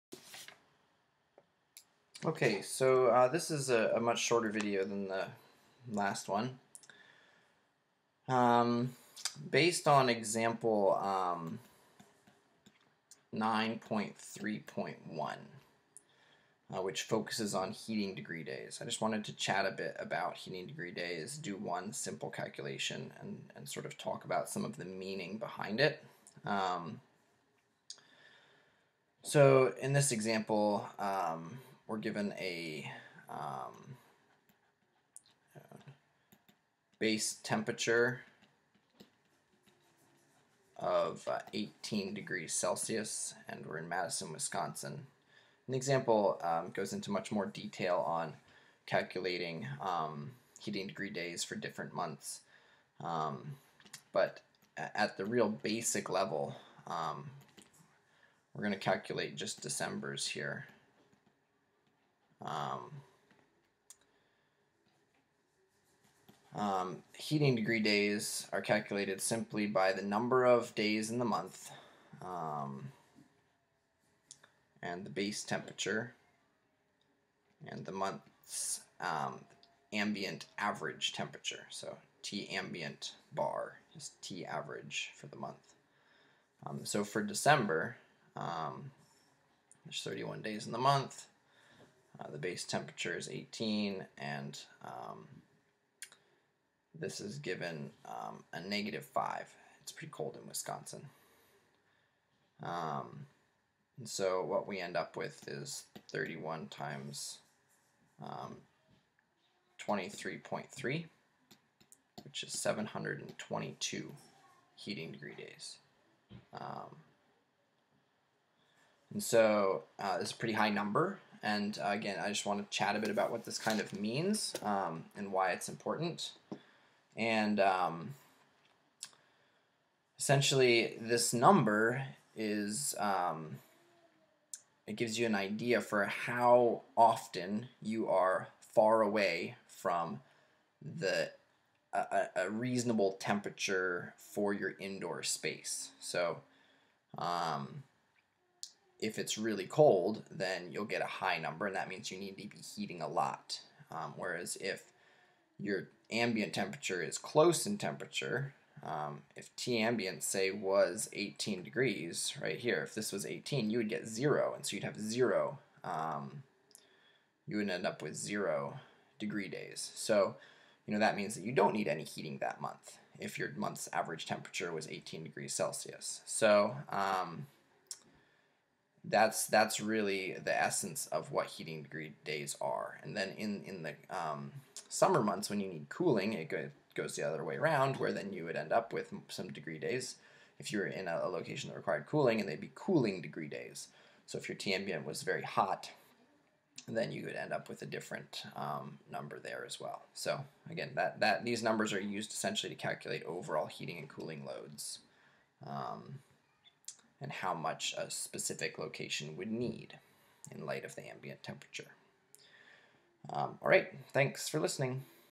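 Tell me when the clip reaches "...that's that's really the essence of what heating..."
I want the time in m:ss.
2:59.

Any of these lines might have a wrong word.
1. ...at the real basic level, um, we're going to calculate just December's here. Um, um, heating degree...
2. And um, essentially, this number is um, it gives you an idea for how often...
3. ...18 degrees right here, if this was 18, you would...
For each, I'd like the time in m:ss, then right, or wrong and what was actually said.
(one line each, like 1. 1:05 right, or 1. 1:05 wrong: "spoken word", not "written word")
1. 0:54 right
2. 2:07 right
3. 2:41 right.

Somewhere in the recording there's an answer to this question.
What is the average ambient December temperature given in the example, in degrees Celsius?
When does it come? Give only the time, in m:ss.
1:38.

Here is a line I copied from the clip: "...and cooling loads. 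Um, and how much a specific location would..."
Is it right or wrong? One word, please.
right.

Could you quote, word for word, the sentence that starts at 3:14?
So if your T ambient was very hot, then you would end up with a different um, number there as well.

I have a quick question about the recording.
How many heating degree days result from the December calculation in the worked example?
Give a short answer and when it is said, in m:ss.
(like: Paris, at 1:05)
722, at 1:52.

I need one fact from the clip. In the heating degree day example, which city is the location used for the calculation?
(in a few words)
Madison, Wisconsin.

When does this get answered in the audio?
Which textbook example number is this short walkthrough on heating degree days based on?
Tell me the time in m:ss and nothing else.
0:13.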